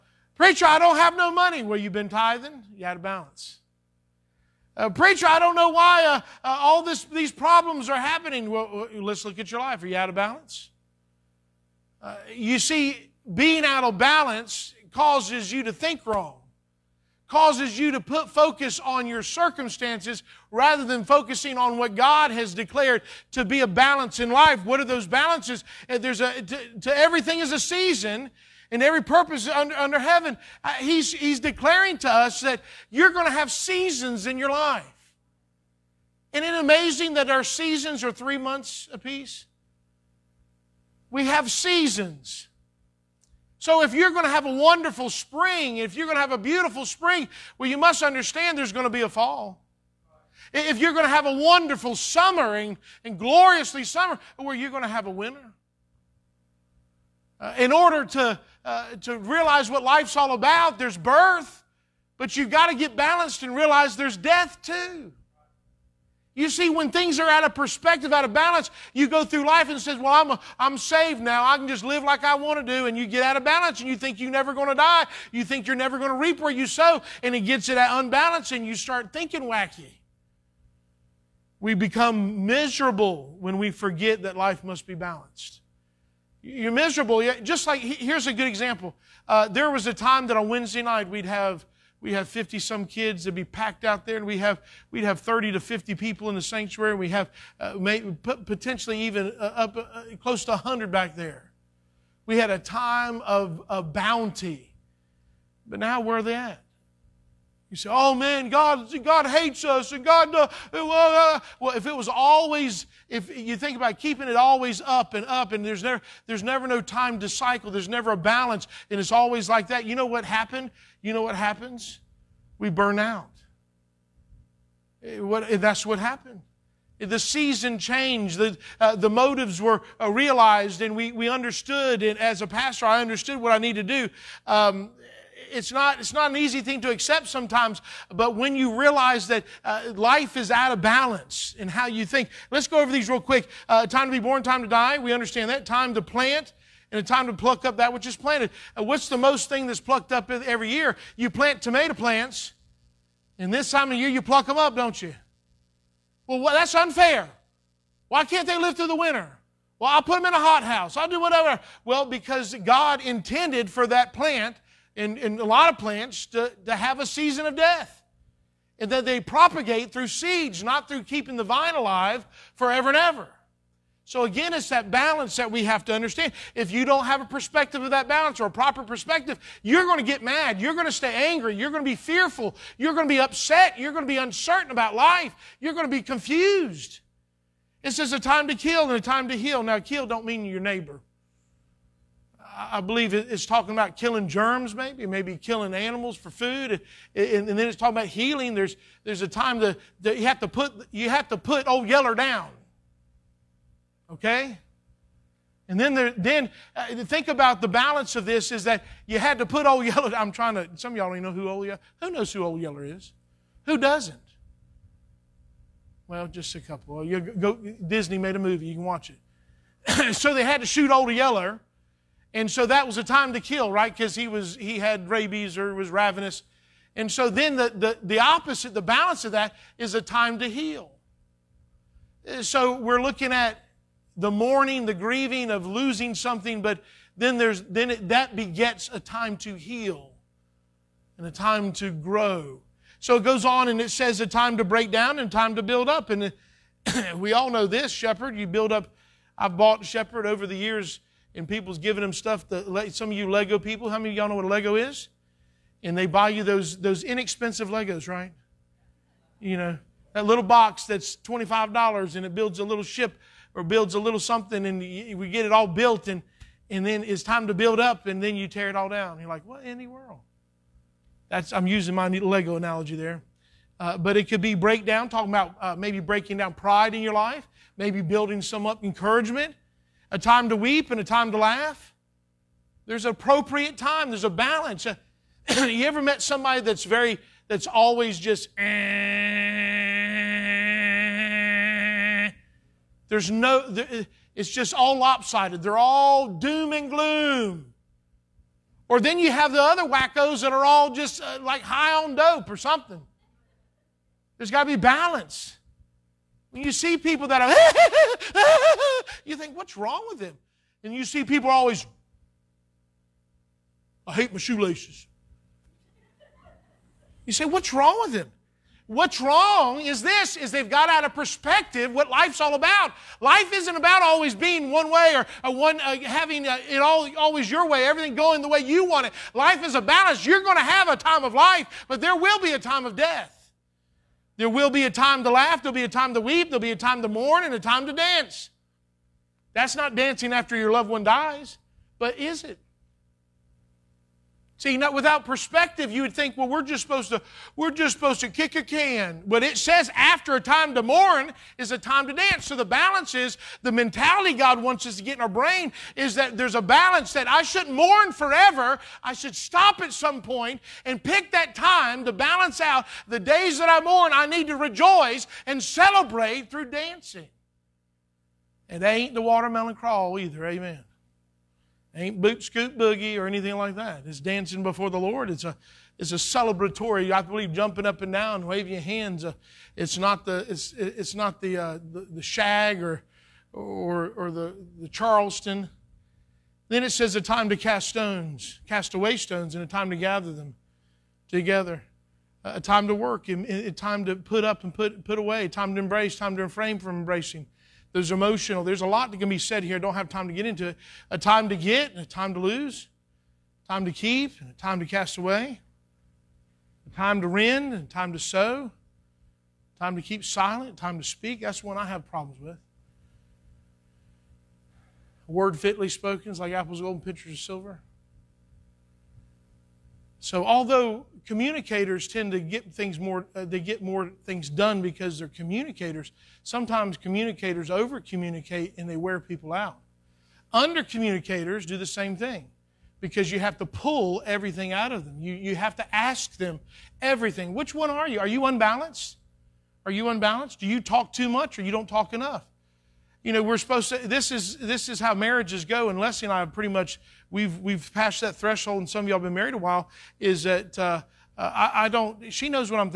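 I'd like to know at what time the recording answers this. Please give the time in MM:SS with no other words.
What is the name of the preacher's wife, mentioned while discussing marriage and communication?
07:25.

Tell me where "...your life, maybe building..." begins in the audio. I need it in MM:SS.
04:37.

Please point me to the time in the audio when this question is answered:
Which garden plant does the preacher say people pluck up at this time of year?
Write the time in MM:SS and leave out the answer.
02:31.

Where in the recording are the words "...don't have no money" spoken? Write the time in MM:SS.
00:00.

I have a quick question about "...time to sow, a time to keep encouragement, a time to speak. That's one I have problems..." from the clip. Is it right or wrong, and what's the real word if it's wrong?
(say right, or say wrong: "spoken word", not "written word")
wrong: "silent", not "encouragement".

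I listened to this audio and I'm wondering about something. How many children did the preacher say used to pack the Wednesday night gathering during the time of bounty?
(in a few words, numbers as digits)
50 some.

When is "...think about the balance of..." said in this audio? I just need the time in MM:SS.
03:27.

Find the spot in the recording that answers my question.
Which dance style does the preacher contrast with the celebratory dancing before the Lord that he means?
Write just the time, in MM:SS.
06:24.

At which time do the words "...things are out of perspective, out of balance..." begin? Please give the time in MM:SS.
01:06.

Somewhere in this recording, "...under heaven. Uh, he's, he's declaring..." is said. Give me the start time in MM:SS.
00:29.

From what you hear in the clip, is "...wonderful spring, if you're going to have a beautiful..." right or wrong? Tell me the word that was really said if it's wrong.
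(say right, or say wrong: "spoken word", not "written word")
right.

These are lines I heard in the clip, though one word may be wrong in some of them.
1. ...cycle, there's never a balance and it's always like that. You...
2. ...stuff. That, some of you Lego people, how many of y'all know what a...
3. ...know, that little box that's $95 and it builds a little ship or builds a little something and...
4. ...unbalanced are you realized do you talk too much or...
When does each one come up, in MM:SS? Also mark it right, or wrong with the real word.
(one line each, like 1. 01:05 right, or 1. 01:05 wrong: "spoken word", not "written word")
1. 01:57 right
2. 04:12 right
3. 04:19 wrong: "25", not "95"
4. 07:18 wrong: "unbalanced", not "realized".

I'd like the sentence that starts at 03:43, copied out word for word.
Because he was he had rabies or was ravenous.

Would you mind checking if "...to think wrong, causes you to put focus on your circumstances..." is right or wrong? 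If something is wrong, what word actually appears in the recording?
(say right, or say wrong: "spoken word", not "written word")
right.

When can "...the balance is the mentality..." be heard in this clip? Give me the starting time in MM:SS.
05:52.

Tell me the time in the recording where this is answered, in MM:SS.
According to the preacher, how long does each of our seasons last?
00:38.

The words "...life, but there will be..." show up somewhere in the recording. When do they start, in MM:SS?
05:31.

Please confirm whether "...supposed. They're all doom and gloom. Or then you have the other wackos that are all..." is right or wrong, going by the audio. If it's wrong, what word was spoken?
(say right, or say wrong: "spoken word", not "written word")
wrong: "lopsided", not "supposed".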